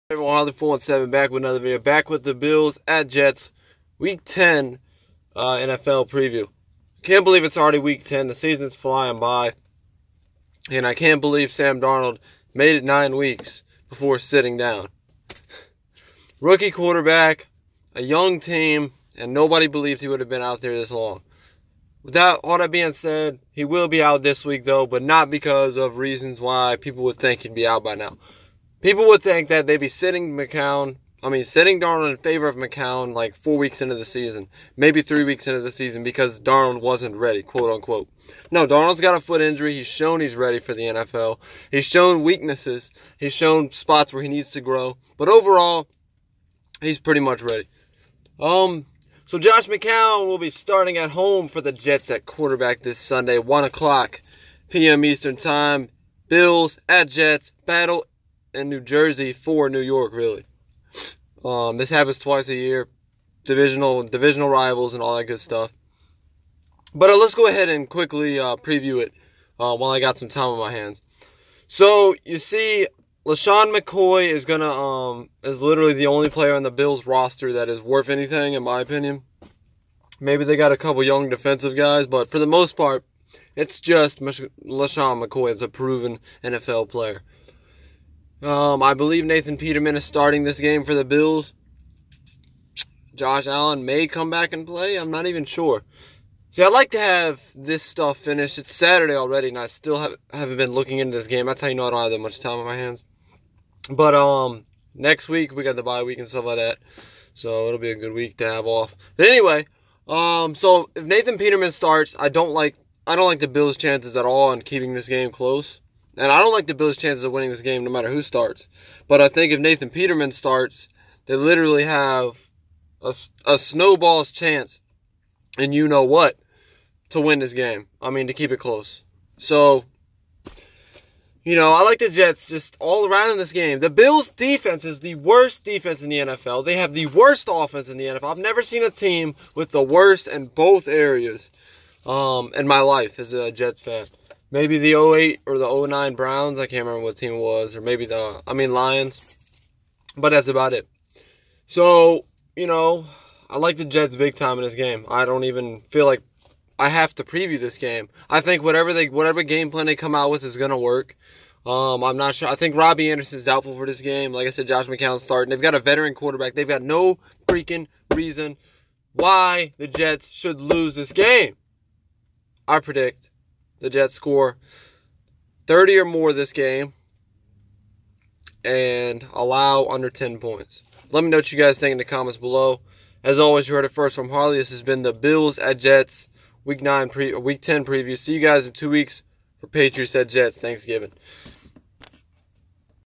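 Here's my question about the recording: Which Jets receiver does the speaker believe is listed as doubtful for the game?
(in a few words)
Robby Anderson.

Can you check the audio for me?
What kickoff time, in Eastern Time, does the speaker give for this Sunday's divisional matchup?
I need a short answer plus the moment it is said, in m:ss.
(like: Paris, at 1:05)
1 p.m., at 0:53.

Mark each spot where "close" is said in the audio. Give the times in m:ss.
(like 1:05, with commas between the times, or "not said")
1:55, 2:08.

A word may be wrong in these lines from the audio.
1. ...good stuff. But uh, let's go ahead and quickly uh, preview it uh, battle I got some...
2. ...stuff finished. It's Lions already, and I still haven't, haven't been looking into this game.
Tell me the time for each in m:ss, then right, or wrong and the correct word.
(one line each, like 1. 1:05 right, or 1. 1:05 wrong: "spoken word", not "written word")
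1. 1:05 wrong: "while", not "battle"
2. 1:37 wrong: "Saturday", not "Lions".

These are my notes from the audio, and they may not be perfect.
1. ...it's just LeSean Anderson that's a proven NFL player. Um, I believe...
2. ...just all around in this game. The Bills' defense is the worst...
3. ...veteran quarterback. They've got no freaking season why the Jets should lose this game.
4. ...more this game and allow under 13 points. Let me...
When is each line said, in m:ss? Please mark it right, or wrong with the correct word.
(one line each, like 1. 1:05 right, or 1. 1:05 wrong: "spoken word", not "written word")
1. 1:23 wrong: "McCoy", not "Anderson"
2. 2:12 right
3. 2:45 wrong: "reason", not "season"
4. 2:56 wrong: "10", not "13".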